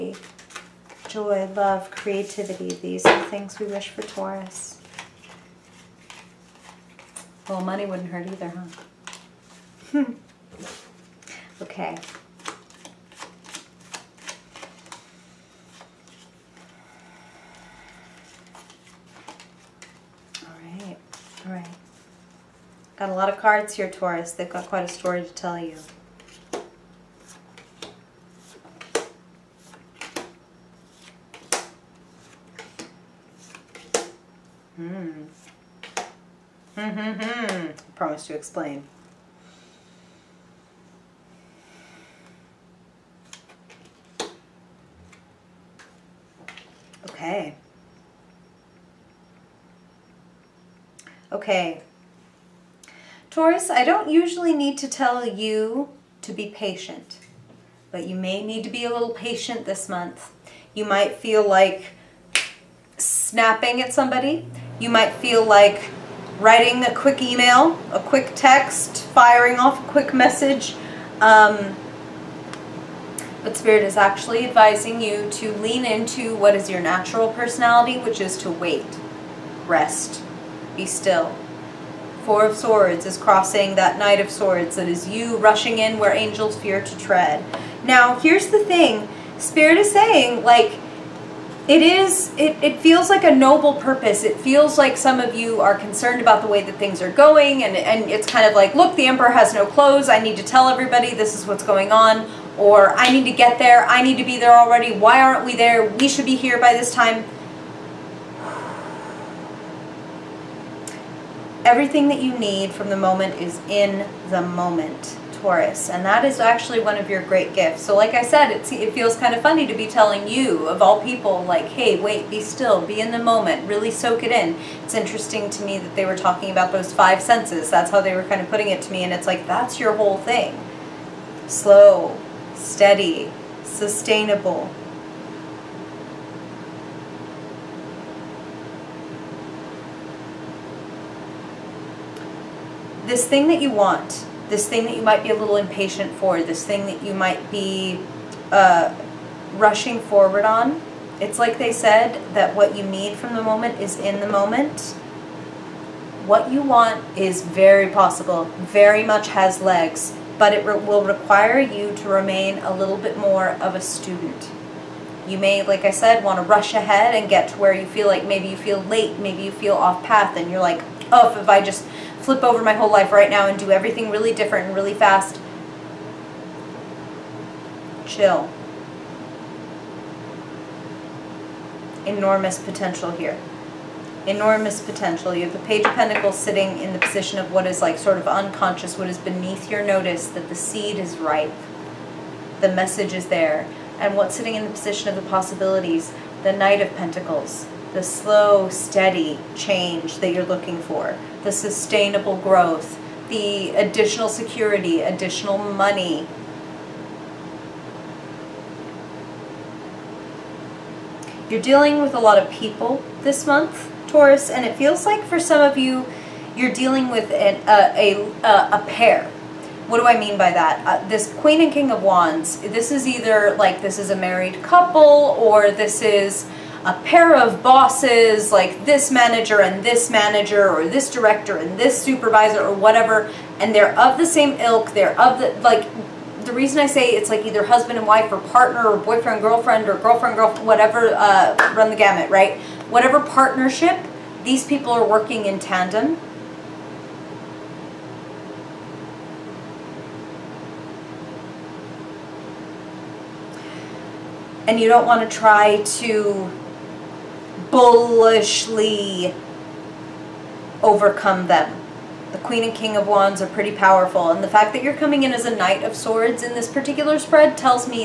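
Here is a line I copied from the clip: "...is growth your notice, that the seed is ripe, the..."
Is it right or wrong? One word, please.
wrong.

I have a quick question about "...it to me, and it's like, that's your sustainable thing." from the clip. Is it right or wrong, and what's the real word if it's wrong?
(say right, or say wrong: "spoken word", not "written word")
wrong: "whole", not "sustainable".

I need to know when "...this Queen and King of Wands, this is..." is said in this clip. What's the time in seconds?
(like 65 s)
221 s.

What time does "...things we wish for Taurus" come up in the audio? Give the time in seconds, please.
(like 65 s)
3 s.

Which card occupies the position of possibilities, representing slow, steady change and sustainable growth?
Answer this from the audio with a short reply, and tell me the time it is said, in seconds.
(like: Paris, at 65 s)
Knight of Pentacles, at 196 s.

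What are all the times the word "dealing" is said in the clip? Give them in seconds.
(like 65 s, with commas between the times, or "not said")
211 s, 216 s.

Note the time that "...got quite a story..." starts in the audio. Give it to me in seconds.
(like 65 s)
24 s.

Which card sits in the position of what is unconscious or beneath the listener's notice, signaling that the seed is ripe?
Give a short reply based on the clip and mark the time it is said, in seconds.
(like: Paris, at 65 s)
Page of Pentacles, at 185 s.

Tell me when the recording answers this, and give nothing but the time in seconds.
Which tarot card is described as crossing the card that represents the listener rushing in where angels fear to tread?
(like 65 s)
82 s.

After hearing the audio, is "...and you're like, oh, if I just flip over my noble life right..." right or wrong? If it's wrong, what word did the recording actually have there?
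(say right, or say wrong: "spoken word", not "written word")
wrong: "whole", not "noble".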